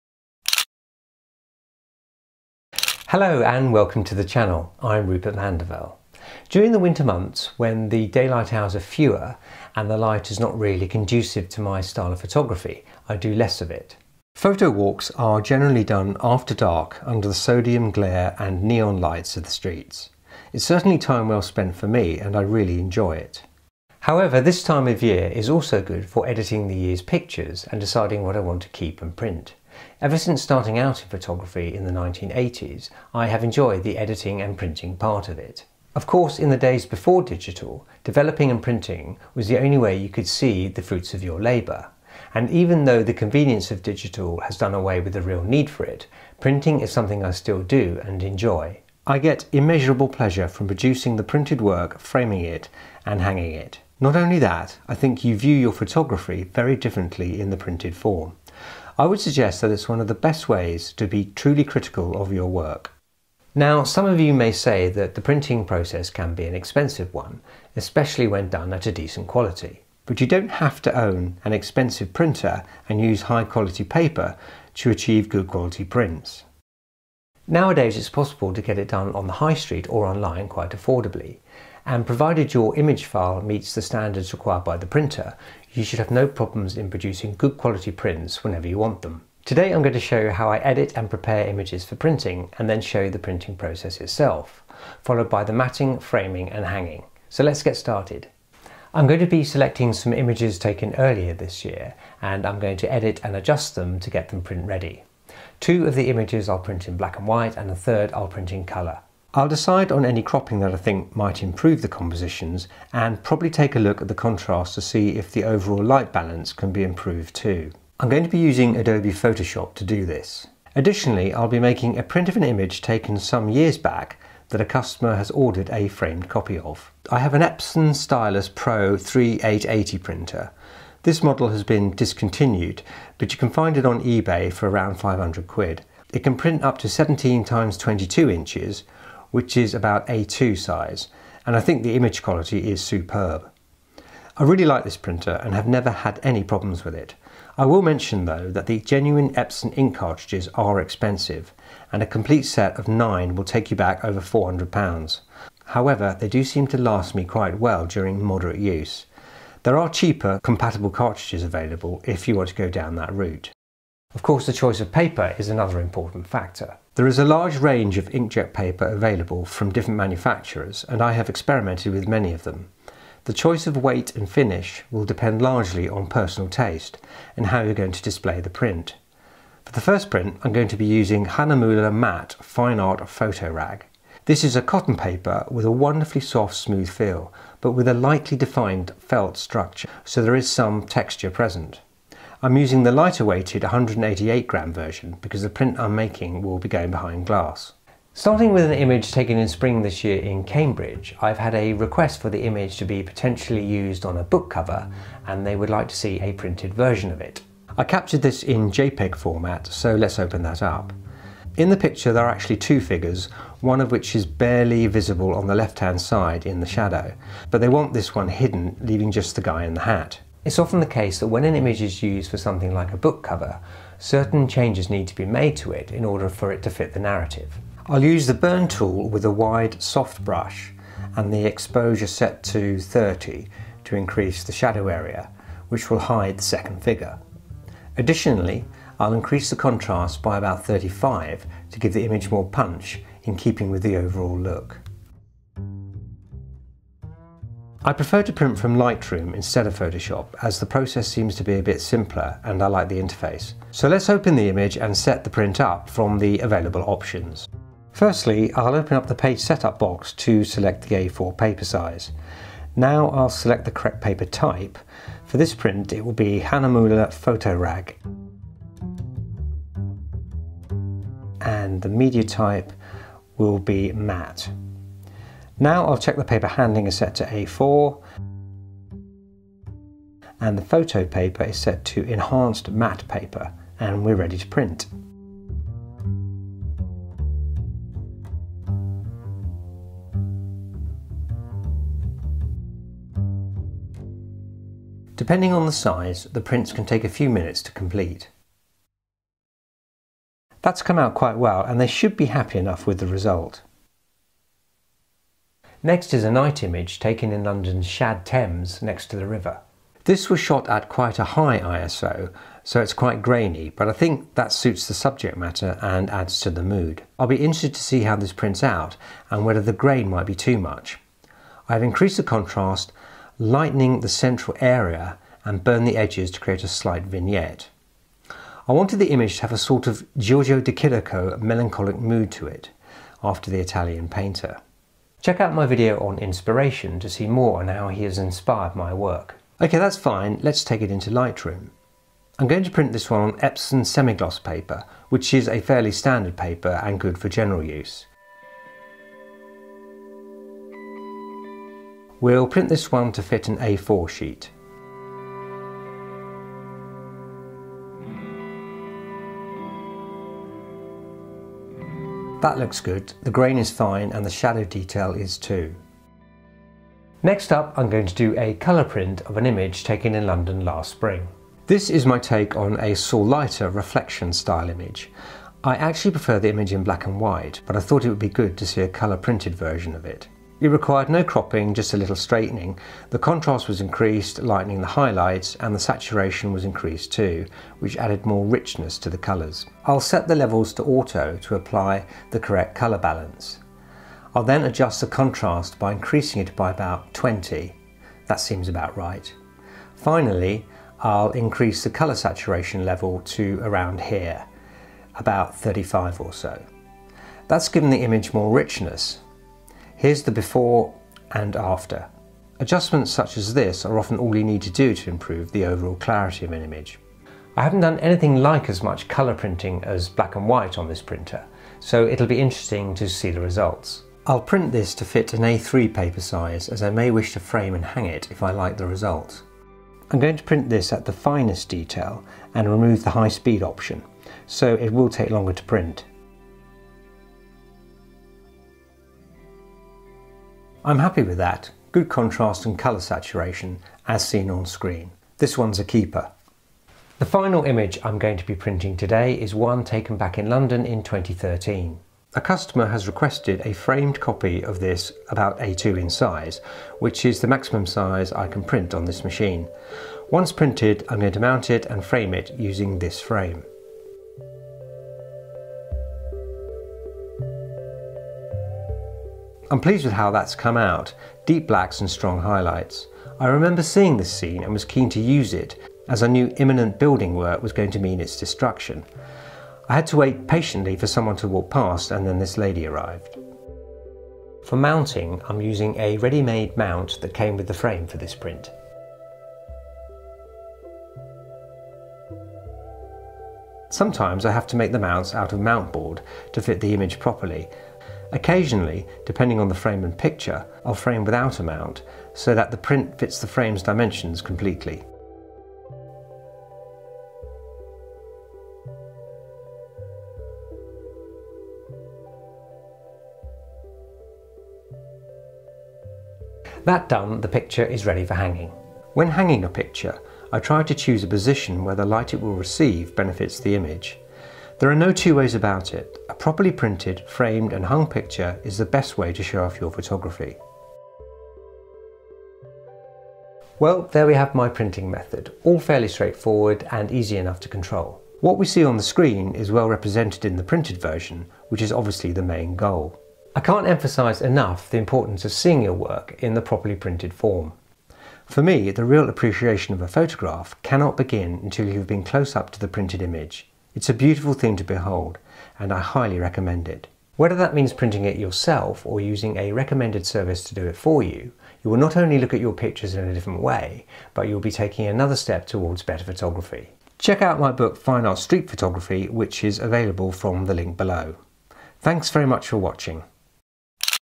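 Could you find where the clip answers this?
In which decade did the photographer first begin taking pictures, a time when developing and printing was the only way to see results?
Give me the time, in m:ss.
0:31.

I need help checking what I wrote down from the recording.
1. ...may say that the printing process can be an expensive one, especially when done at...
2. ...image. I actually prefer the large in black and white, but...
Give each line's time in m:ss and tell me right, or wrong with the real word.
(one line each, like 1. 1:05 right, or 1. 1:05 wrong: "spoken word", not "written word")
1. 1:04 right
2. 6:14 wrong: "image", not "large".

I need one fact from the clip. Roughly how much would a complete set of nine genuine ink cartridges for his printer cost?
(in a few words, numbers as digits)
Over £400.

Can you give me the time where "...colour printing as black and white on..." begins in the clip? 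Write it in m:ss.
6:59.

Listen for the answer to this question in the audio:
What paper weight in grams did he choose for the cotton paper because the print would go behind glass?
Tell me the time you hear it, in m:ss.
3:13.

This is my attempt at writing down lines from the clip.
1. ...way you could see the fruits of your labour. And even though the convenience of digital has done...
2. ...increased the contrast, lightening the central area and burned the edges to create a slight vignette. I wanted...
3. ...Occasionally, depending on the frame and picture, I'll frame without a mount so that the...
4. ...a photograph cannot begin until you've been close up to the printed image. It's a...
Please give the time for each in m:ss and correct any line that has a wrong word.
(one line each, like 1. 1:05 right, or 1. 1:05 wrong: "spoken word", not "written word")
1. 0:39 right
2. 5:21 right
3. 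8:18 right
4. 9:10 right.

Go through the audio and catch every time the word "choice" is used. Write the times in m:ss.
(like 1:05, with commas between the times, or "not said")
2:44, 2:53.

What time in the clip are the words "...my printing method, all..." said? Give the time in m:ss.
8:54.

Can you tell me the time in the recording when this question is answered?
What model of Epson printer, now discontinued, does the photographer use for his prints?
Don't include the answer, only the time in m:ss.
2:07.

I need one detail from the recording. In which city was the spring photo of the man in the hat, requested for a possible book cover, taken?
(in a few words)
Cambridge.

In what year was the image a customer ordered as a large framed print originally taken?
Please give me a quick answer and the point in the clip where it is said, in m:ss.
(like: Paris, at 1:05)
2013, at 7:31.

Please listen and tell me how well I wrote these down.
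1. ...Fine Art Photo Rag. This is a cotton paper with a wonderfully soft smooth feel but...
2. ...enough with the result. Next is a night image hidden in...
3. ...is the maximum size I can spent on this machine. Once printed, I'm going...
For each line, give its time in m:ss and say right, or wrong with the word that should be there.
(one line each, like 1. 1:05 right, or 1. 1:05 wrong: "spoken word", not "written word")
1. 3:02 right
2. 5:02 wrong: "taken", not "hidden"
3. 7:37 wrong: "print", not "spent".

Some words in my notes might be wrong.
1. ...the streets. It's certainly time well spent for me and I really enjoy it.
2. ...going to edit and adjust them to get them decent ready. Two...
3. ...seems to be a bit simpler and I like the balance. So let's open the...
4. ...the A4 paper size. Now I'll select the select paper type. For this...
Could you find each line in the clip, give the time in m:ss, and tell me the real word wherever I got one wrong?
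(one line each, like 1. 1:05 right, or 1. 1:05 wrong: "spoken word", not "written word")
1. 0:19 right
2. 1:42 wrong: "print", not "decent"
3. 4:11 wrong: "interface", not "balance"
4. 4:20 wrong: "correct", not "select".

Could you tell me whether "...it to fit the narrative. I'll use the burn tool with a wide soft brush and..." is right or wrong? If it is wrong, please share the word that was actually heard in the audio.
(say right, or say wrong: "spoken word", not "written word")
right.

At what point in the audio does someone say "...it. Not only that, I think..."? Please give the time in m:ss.
0:53.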